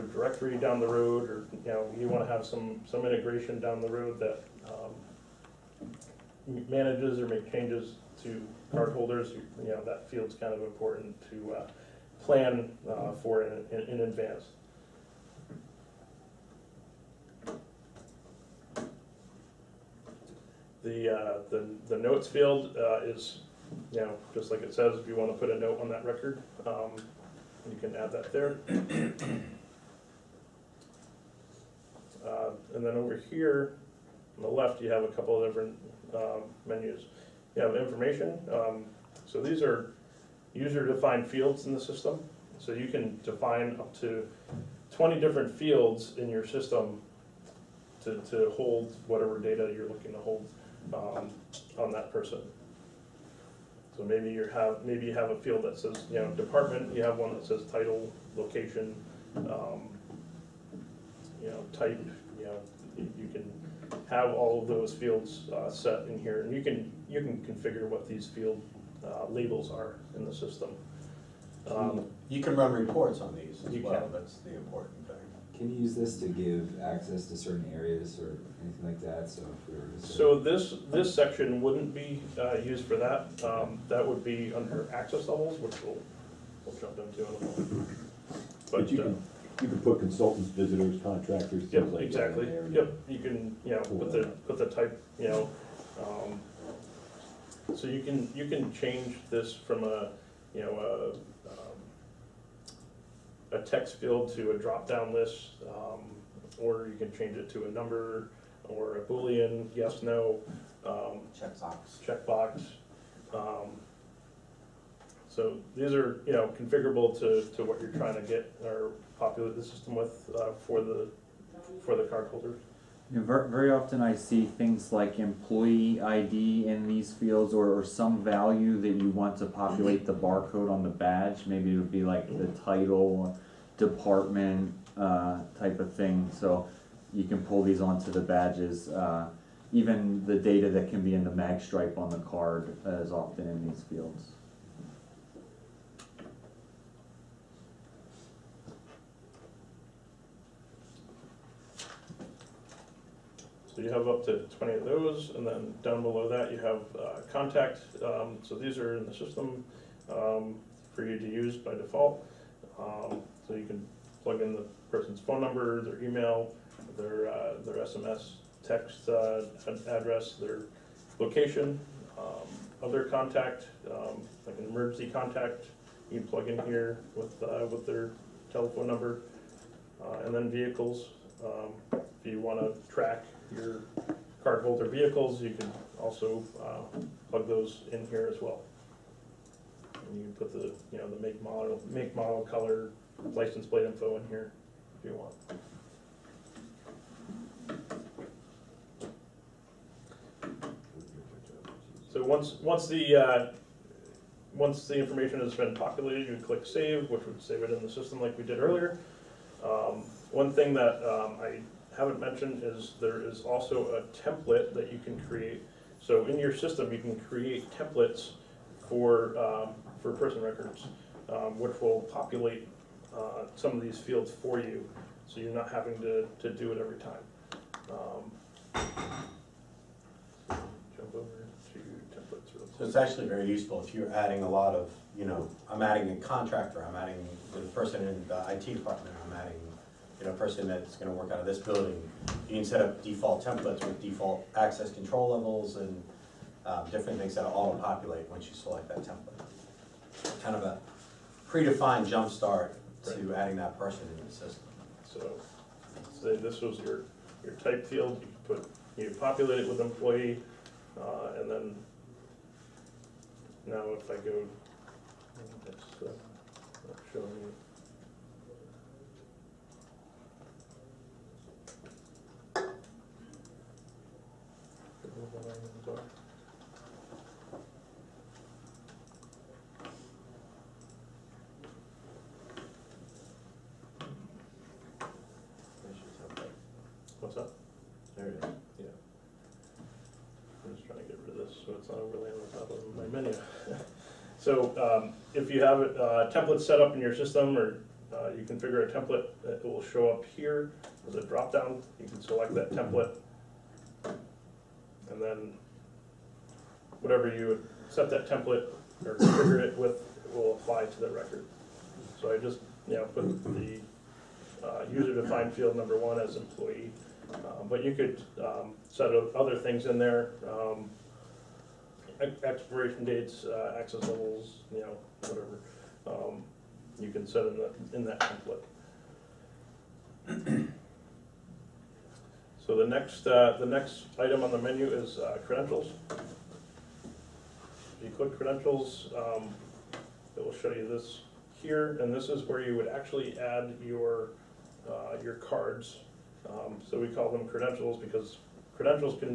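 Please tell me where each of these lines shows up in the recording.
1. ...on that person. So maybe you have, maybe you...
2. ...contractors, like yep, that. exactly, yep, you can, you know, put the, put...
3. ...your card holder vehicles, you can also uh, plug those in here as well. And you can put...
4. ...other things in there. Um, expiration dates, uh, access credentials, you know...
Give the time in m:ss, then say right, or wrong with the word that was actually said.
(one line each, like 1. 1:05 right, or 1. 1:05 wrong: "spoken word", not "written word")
1. 0:51 right
2. 1:31 right
3. 3:03 right
4. 5:19 wrong: "levels", not "credentials".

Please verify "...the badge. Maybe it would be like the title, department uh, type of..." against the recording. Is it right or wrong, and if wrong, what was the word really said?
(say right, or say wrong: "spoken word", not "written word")
right.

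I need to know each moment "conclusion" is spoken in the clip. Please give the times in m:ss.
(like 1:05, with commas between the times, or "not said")
not said.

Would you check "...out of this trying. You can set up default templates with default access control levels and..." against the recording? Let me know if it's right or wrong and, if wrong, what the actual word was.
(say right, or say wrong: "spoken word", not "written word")
wrong: "building", not "trying".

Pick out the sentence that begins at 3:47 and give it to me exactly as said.
Um, jump over to templates real quick.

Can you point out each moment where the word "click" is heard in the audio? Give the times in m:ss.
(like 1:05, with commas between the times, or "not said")
3:26, 5:38.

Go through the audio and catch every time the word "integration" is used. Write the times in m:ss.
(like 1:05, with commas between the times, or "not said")
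0:03.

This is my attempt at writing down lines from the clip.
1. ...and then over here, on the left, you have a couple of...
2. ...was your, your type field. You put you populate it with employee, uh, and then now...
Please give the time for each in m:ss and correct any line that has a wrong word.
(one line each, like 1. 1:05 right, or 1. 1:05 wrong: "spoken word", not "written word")
1. 0:32 right
2. 4:16 right.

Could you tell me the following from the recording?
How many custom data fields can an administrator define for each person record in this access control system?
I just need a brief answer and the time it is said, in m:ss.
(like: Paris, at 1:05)
20, at 0:44.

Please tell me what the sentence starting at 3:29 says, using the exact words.
Um, one thing that um, I haven't mentioned is there is also a template that you can create.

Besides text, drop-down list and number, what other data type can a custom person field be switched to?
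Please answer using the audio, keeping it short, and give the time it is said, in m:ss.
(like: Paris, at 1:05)
boolean, at 1:49.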